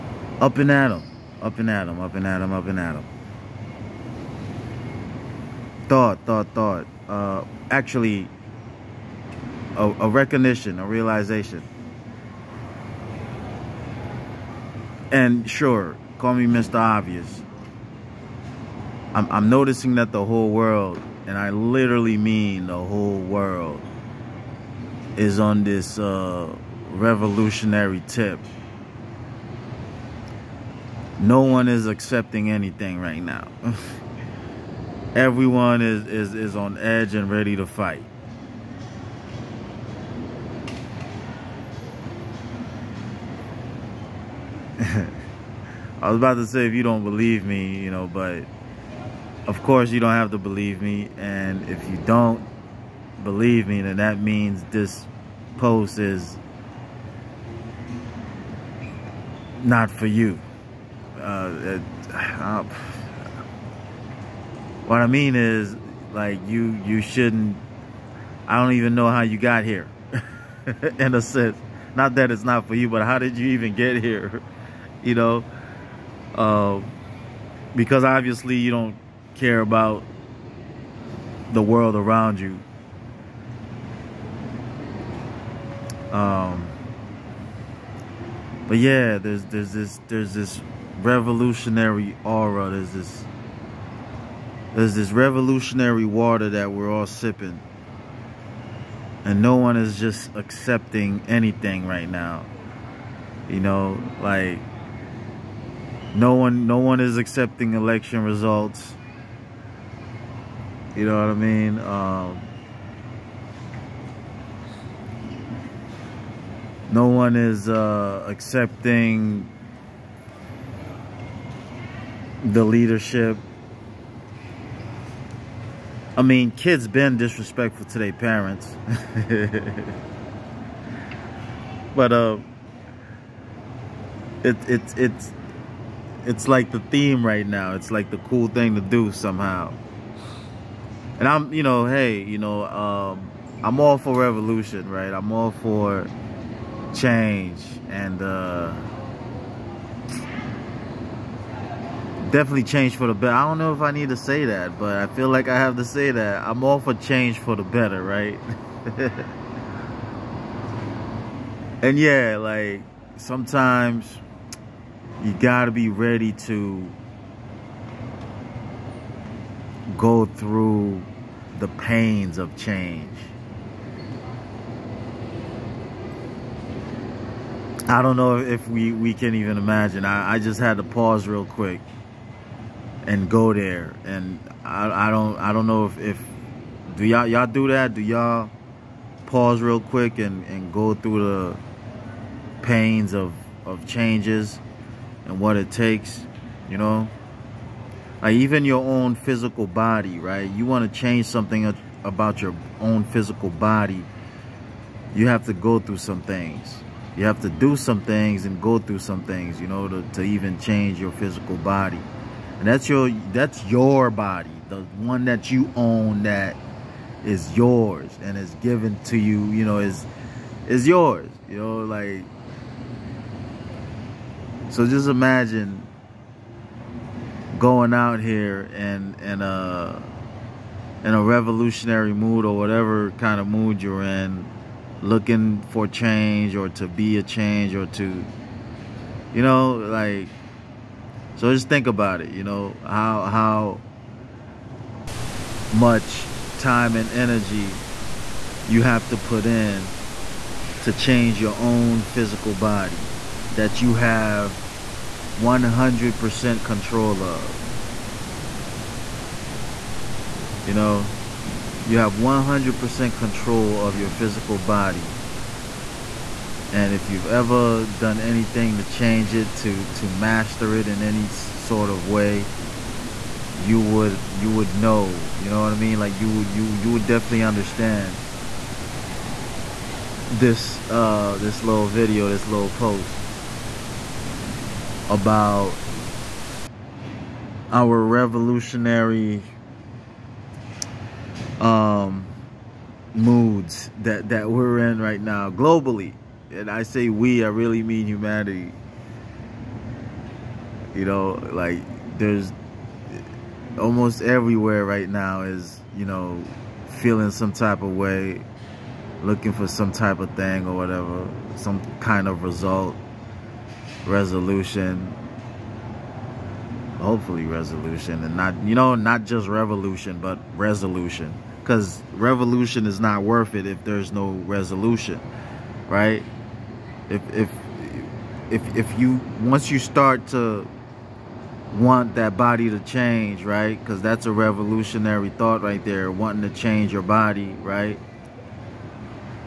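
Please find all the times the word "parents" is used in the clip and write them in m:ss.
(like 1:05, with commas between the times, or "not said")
2:08.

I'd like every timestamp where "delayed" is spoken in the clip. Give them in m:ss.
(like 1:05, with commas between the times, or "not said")
not said.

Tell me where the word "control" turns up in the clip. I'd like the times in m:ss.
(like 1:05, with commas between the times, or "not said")
4:16, 4:23.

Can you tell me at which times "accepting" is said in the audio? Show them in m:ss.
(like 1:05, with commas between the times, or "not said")
0:31, 1:40, 1:47, 1:58.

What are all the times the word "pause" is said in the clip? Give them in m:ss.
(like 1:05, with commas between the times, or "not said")
3:00, 3:09.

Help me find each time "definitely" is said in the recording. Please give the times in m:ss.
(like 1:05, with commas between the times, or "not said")
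2:32, 4:37.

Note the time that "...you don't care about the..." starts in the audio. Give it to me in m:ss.
1:18.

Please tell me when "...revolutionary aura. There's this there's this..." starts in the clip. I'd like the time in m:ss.
1:31.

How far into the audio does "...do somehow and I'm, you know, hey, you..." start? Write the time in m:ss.
2:18.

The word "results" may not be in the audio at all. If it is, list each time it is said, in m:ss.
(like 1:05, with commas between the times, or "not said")
1:48, 5:12.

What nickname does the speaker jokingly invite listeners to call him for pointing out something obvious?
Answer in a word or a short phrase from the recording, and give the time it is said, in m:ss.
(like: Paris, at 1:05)
Mr. Obvious, at 0:16.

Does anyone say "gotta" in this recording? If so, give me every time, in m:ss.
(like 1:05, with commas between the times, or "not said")
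2:45.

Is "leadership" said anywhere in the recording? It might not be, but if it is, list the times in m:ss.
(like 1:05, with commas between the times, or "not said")
2:02.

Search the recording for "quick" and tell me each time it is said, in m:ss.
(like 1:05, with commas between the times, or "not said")
3:01, 3:09.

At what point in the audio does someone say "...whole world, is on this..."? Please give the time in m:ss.
0:22.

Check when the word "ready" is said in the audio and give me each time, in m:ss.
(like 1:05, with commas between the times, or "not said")
0:37, 2:45.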